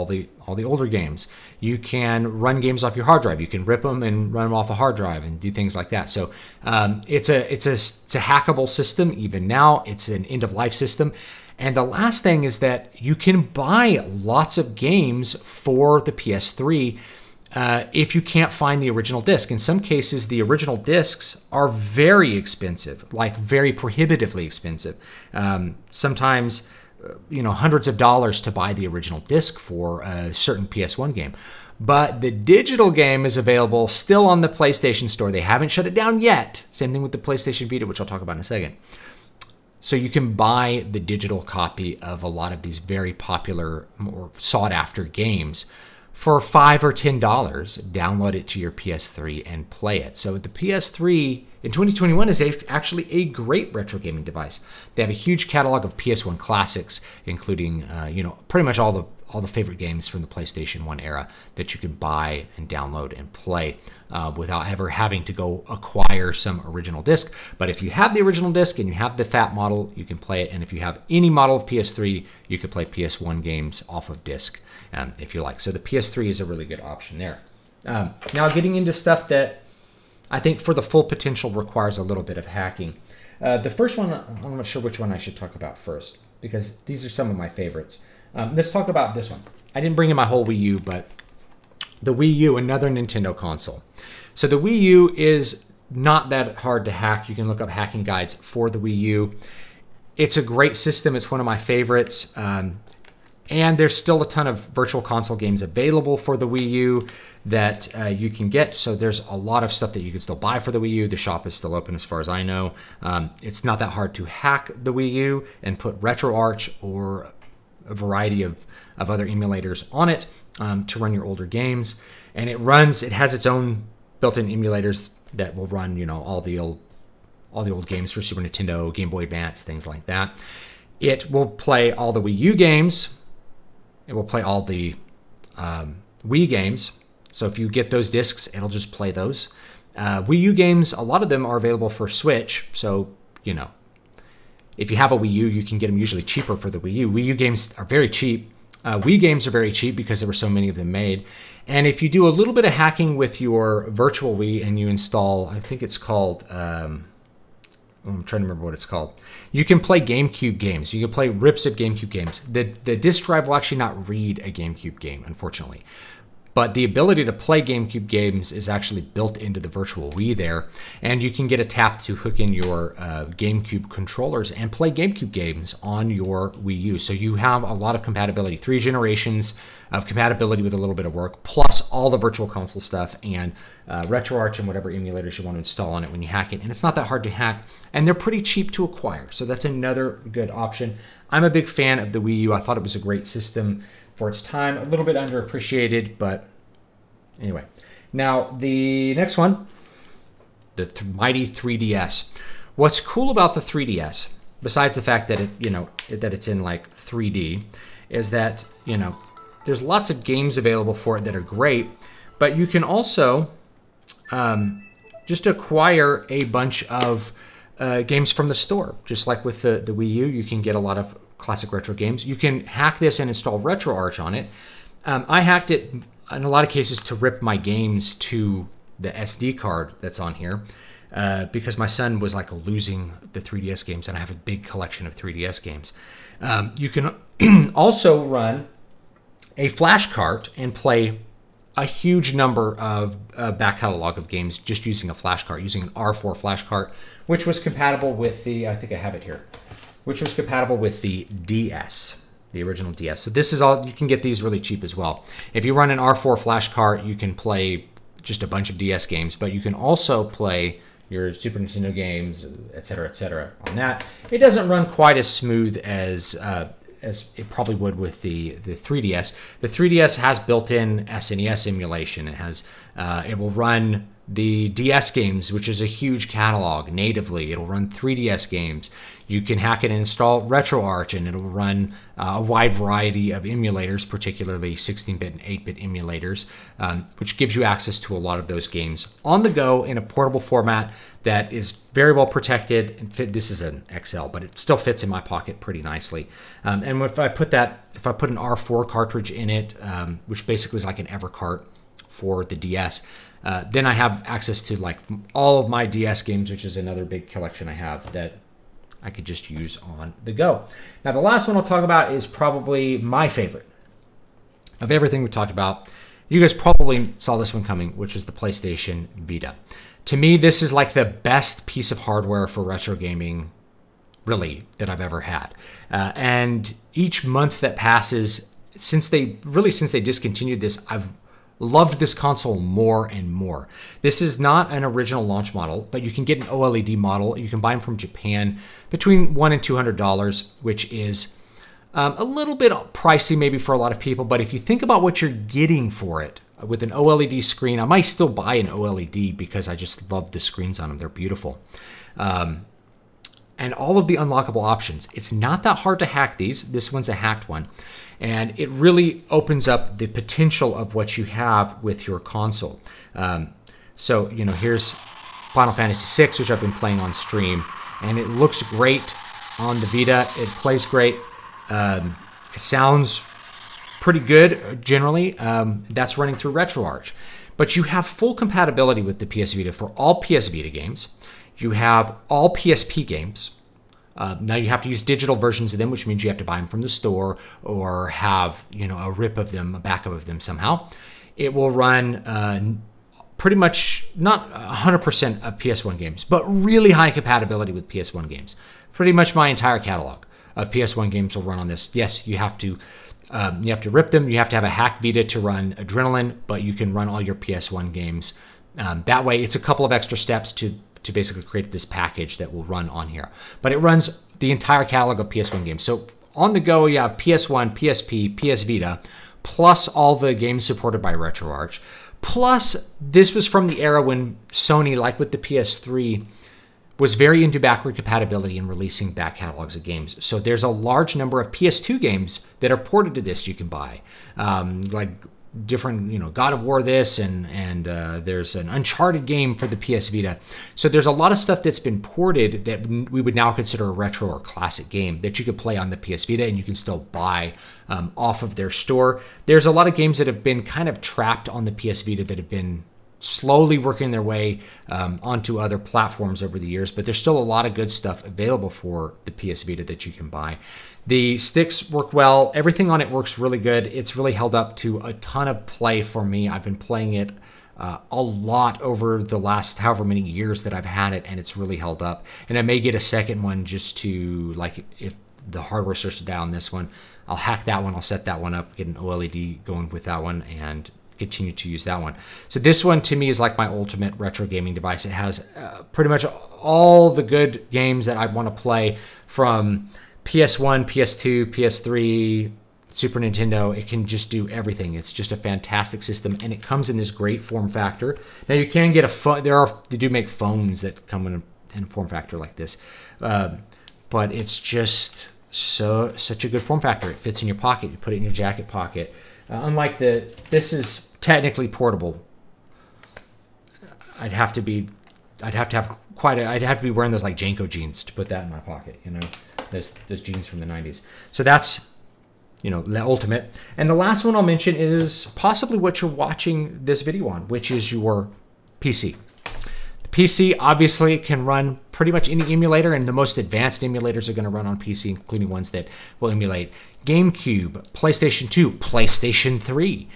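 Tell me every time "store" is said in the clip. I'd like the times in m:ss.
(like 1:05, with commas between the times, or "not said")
0:35, 3:38, 6:26, 7:28.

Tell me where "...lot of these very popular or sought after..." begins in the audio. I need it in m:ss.
0:42.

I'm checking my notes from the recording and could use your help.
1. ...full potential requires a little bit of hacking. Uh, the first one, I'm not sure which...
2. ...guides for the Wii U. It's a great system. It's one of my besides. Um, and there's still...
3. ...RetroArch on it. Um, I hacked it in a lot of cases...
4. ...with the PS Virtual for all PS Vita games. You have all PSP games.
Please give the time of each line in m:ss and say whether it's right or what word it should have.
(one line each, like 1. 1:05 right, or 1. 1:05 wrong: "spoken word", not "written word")
1. 1:20 right
2. 1:38 wrong: "favorites", not "besides"
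3. 3:43 right
4. 6:19 wrong: "Vita", not "Virtual".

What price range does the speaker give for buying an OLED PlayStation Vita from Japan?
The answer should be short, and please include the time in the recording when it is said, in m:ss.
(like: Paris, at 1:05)
$100 to $200, at 5:39.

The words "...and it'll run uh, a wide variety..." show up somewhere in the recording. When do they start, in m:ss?
4:41.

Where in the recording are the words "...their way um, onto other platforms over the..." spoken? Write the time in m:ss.
7:34.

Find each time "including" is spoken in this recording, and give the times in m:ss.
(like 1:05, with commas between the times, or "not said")
0:57, 8:55.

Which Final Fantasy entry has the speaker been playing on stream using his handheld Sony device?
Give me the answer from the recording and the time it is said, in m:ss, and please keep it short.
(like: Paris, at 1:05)
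Final Fantasy VI, at 6:05.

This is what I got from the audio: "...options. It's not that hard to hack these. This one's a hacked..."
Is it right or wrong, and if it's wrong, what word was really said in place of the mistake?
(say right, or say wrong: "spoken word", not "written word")
right.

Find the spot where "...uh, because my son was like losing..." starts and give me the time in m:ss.
3:51.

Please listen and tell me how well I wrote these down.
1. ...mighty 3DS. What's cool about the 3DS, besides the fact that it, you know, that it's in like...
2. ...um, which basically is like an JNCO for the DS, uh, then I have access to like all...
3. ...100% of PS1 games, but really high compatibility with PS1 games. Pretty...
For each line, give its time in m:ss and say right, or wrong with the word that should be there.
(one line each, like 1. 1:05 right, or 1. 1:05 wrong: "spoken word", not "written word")
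1. 3:21 right
2. 4:59 wrong: "Evercart", not "JNCO"
3. 6:34 right.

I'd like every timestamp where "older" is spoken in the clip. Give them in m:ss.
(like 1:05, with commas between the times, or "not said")
0:00, 2:01.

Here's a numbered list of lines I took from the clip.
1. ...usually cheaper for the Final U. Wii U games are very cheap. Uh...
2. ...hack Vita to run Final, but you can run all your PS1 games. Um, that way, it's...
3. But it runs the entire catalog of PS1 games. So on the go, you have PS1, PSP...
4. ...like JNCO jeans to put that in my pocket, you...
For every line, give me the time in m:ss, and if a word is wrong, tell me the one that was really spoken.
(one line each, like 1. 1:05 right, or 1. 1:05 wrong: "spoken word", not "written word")
1. 2:25 wrong: "Wii", not "Final"
2. 6:44 wrong: "Adrenaline", not "Final"
3. 6:53 right
4. 8:37 right.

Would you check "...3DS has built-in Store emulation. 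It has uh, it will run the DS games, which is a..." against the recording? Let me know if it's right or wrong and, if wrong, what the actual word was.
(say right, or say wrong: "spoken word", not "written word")
wrong: "SNES", not "Store".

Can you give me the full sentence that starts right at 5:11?
Now, the last one I'll talk about is probably my favorite of everything we talked about.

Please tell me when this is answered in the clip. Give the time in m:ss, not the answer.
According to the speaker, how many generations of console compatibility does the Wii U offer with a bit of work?
2:58.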